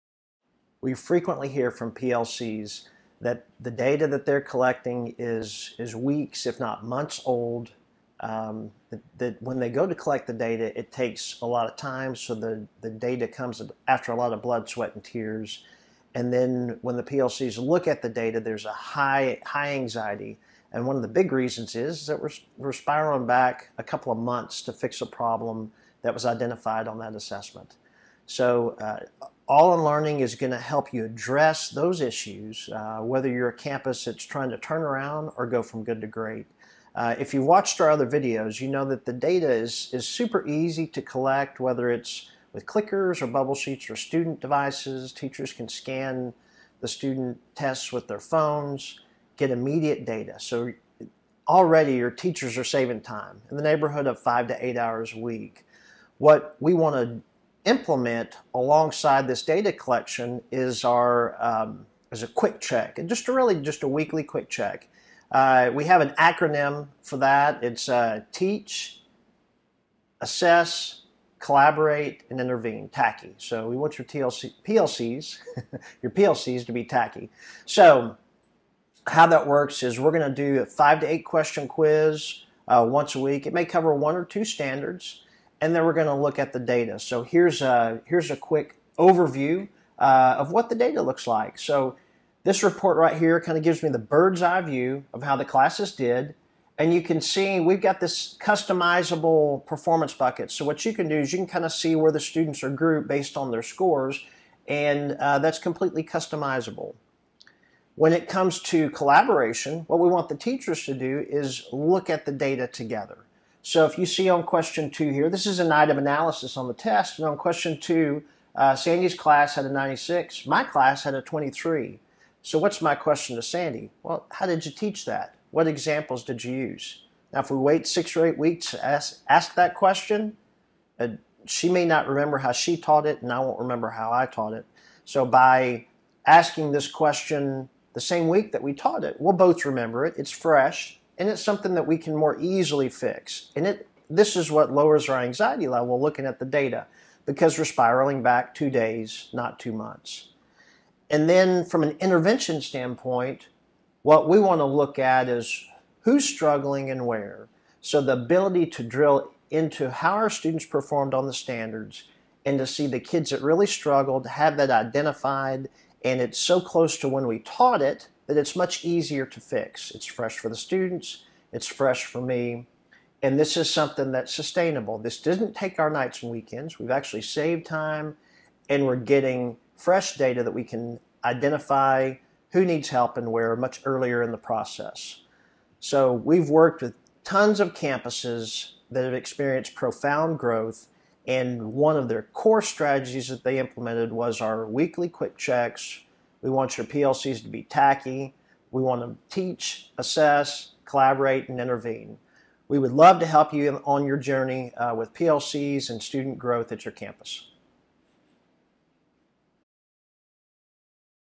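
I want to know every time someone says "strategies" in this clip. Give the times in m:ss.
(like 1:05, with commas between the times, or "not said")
3:12.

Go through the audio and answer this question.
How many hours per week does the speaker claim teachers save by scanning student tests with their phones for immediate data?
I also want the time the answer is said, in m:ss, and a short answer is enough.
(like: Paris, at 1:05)
5 to 8, at 0:54.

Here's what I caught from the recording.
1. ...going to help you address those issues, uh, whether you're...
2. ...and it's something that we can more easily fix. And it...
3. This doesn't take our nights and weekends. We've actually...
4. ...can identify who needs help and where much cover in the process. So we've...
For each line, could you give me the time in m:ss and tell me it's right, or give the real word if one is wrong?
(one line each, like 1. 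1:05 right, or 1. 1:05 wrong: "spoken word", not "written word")
1. 0:30 right
2. 2:21 right
3. 2:54 right
4. 3:00 wrong: "earlier", not "cover".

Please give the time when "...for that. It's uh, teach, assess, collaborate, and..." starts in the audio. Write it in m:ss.
1:07.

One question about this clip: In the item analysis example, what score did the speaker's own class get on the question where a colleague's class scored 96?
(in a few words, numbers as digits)
23.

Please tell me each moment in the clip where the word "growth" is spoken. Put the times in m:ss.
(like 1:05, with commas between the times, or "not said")
3:10, 3:26.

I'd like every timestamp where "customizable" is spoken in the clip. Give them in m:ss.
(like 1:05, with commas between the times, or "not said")
1:38, 1:46.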